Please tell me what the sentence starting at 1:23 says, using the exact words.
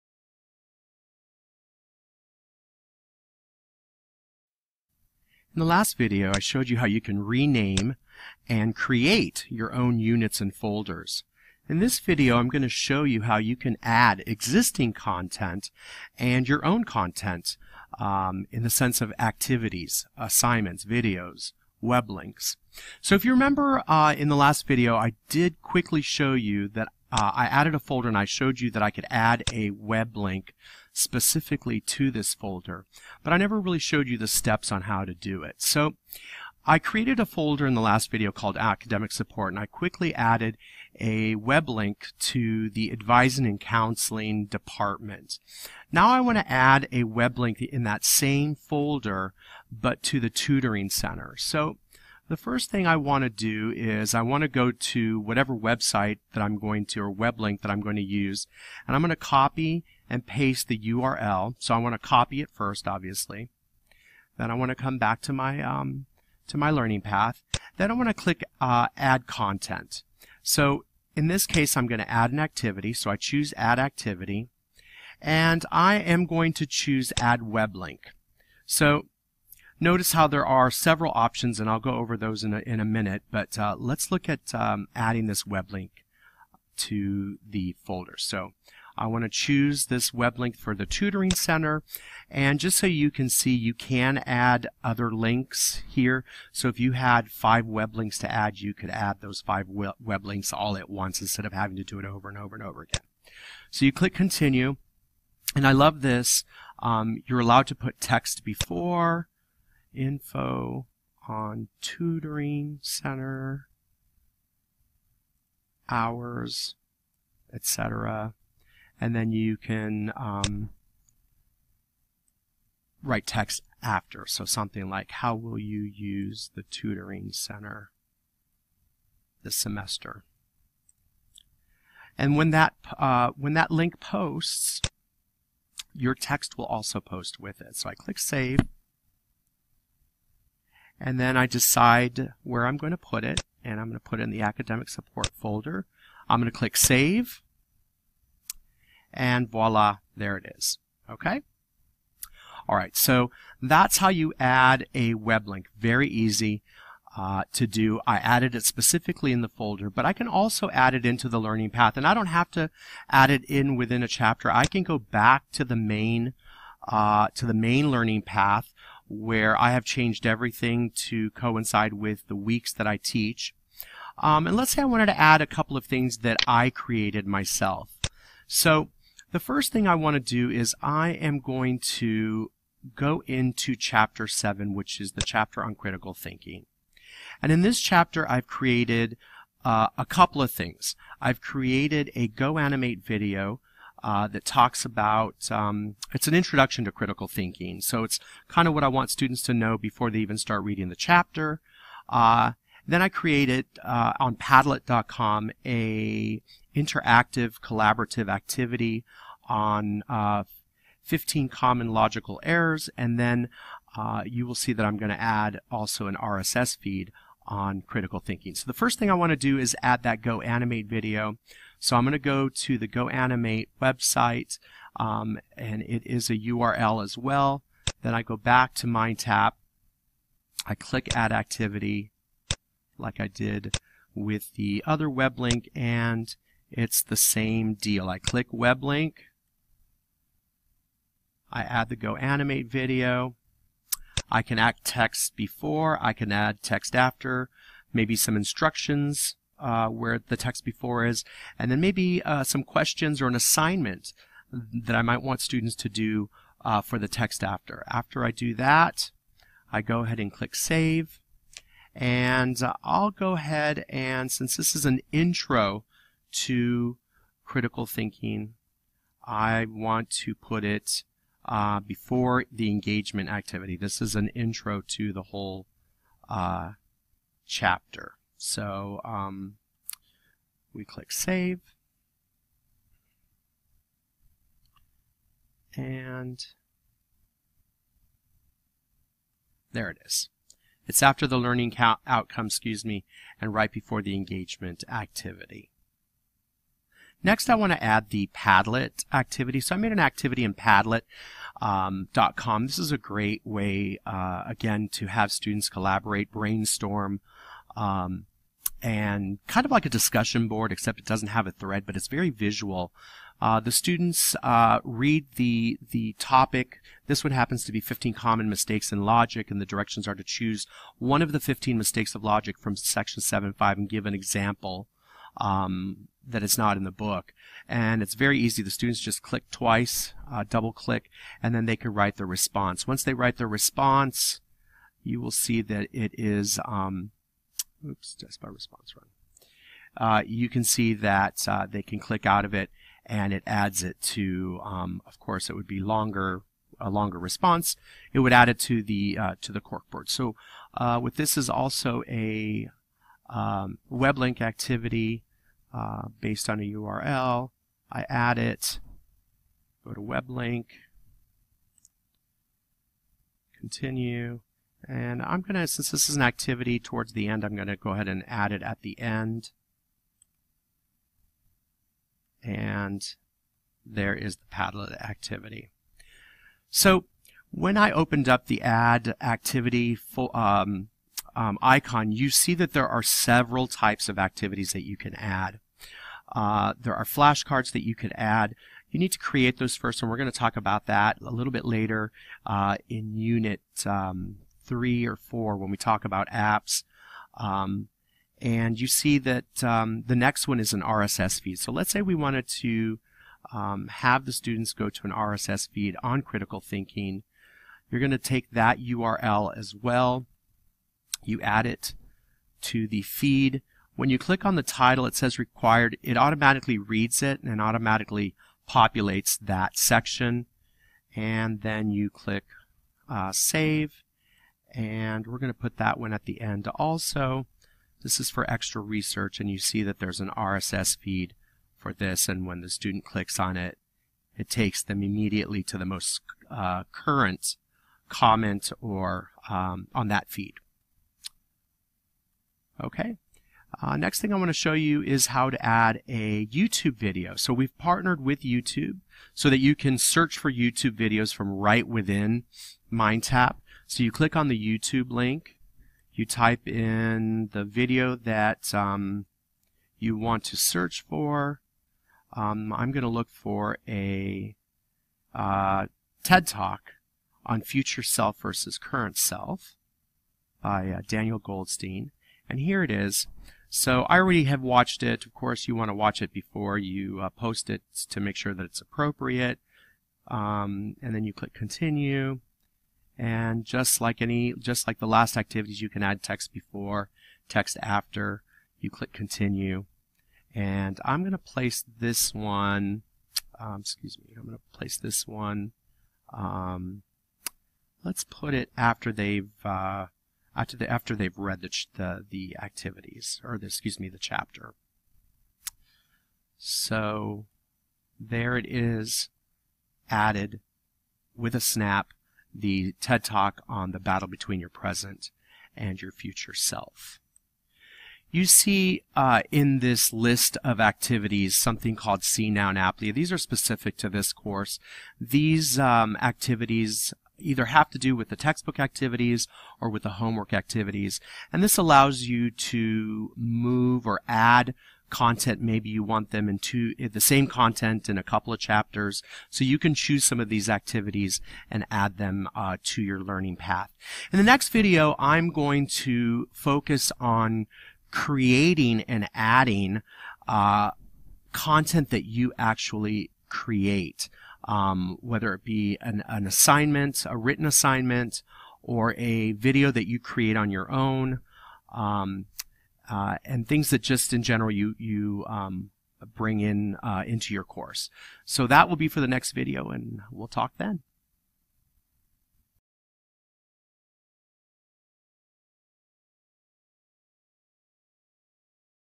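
But uh, let's look at um, adding this web link to the folder.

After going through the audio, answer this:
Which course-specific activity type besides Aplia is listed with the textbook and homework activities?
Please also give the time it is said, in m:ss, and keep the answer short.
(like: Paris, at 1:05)
CNOW, at 8:42.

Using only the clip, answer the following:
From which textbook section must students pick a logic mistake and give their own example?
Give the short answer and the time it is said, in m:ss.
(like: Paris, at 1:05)
7.5, at 5:22.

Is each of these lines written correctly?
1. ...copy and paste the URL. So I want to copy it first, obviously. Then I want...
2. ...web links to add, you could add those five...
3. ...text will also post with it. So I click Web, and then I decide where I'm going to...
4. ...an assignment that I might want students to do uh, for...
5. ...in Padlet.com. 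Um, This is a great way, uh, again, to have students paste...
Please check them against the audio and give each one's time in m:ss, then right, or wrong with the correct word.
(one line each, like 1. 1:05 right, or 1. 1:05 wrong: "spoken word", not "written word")
1. 0:59 right
2. 1:37 right
3. 2:16 wrong: "Save", not "Web"
4. 4:13 right
5. 5:00 wrong: "collaborate", not "paste".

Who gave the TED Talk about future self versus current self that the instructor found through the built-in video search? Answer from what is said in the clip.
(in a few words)
Daniel Goldstein.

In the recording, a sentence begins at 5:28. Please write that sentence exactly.
The students just click twice, uh, double click, and then they can write their response.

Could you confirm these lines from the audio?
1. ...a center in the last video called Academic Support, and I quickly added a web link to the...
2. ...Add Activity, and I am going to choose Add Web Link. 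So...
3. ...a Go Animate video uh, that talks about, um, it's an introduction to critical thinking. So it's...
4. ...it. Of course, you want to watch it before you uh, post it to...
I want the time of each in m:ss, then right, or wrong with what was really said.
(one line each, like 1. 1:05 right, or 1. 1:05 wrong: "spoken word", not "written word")
1. 0:37 wrong: "folder", not "center"
2. 1:13 right
3. 3:12 right
4. 7:55 right.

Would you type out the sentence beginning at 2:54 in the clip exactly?
Um, and let's say I wanted to add a couple of things that I created myself.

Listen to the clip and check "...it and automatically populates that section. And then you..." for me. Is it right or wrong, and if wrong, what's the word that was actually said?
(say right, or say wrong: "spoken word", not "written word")
right.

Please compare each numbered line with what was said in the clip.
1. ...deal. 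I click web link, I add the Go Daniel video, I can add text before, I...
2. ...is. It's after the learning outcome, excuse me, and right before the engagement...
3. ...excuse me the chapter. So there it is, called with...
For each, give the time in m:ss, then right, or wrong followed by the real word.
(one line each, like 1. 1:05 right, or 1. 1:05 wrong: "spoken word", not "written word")
1. 3:57 wrong: "Animate", not "Daniel"
2. 4:50 right
3. 8:23 wrong: "added", not "called".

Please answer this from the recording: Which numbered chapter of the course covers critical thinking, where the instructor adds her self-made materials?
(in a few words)
7.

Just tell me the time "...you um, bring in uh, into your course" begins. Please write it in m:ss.
9:24.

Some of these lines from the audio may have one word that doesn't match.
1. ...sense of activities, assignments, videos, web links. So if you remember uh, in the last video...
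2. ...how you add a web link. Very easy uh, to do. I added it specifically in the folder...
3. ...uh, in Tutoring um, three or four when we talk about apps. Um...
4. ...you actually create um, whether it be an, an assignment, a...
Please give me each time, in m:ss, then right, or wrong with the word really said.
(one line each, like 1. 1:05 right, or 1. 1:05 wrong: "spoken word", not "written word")
1. 0:18 right
2. 2:33 right
3. 6:32 wrong: "Unit", not "Tutoring"
4. 9:12 right.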